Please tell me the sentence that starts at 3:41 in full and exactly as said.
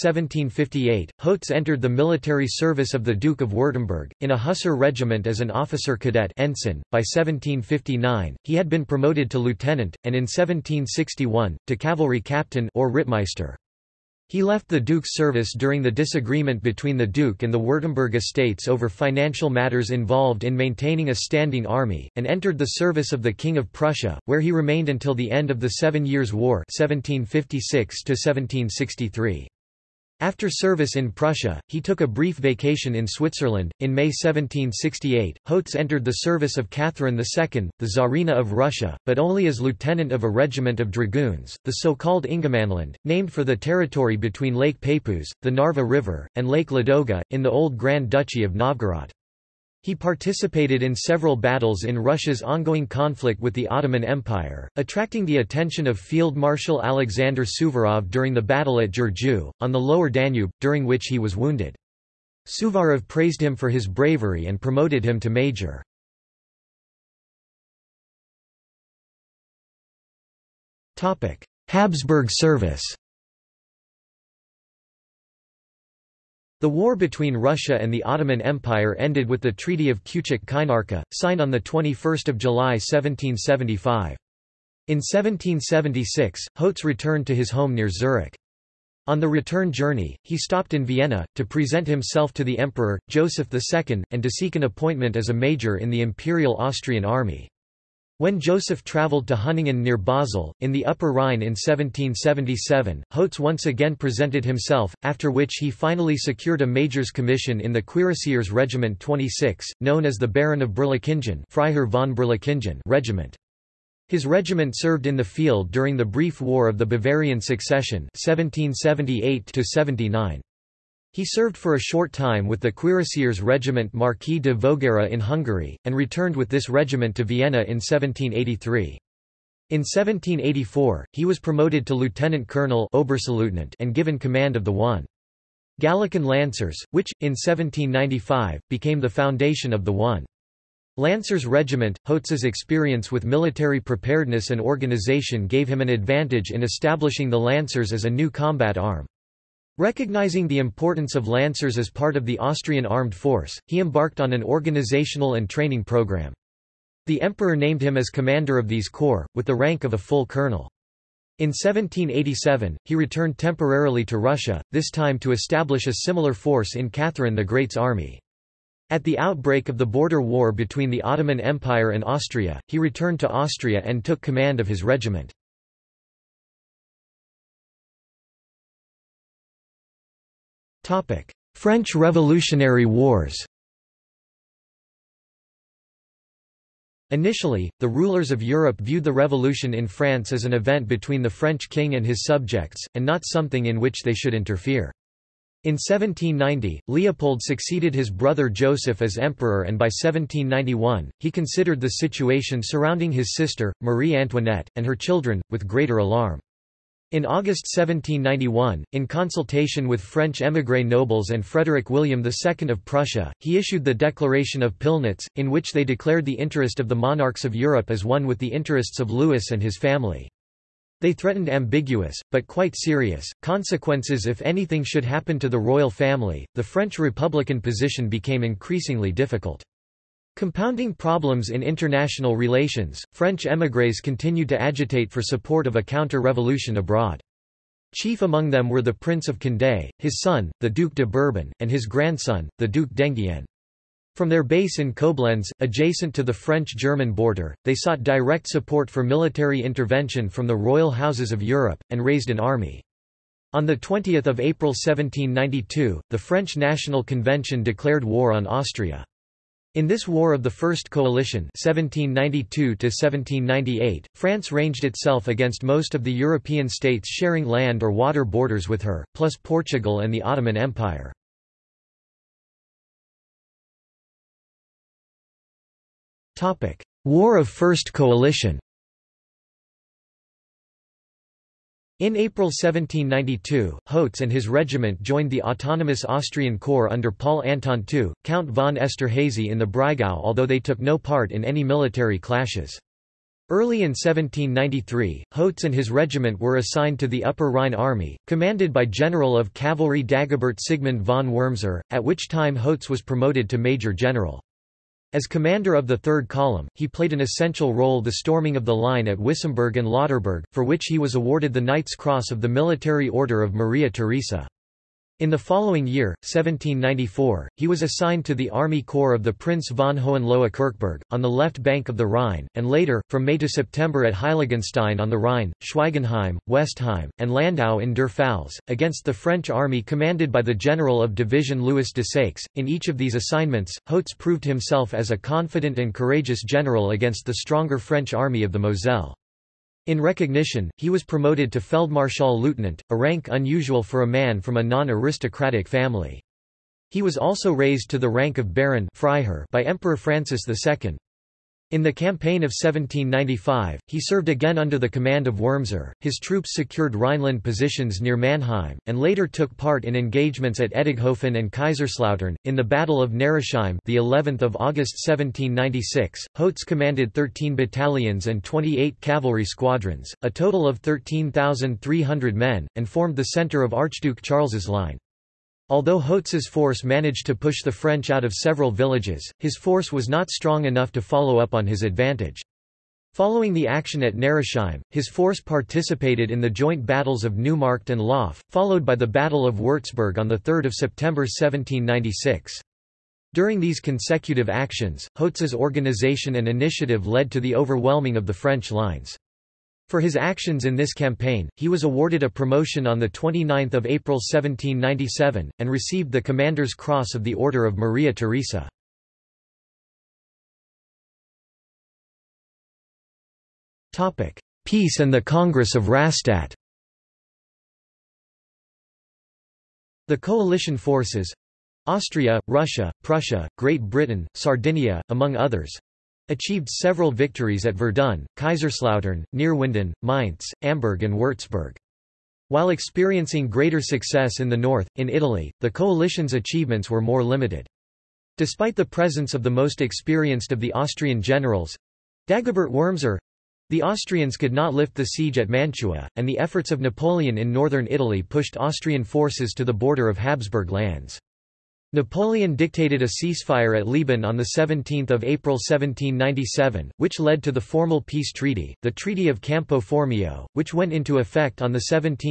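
They threatened ambiguous, but quite serious, consequences if anything should happen to the royal family.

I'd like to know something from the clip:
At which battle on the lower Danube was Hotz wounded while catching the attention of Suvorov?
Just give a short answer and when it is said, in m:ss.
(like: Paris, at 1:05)
Giurgiu, at 0:58.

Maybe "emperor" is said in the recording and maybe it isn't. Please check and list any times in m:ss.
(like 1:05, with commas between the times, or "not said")
1:32, 2:37, 3:19, 5:49.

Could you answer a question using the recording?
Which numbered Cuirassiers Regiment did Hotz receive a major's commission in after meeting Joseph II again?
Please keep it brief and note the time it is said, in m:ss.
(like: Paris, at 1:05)
26, at 1:48.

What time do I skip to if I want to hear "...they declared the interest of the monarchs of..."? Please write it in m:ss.
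3:35.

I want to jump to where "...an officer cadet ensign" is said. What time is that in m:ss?
0:05.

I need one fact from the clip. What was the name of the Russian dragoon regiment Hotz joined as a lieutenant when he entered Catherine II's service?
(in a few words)
Ingermanland.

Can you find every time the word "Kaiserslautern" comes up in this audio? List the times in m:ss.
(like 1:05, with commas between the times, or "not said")
6:01, 7:08.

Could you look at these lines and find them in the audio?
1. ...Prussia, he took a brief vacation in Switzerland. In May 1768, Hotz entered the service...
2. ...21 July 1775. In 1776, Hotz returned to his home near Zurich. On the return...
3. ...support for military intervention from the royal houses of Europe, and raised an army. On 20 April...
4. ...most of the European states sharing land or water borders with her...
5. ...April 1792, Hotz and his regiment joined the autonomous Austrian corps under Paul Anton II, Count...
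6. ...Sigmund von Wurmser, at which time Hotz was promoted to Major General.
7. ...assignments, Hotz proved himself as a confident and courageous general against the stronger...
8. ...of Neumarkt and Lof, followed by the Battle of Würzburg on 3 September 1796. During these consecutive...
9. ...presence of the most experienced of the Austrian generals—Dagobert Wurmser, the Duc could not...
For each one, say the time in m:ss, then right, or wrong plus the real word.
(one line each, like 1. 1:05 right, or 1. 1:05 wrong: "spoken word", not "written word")
1. 0:31 right
2. 1:21 right
3. 4:08 right
4. 4:25 right
5. 4:42 right
6. 5:00 right
7. 5:33 right
8. 6:27 right
9. 7:18 wrong: "Austrians", not "Duc".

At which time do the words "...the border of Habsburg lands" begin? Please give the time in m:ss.
7:29.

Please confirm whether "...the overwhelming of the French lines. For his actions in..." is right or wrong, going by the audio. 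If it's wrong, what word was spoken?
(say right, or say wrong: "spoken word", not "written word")
right.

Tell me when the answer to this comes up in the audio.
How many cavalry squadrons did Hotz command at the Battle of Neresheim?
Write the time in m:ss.
6:08.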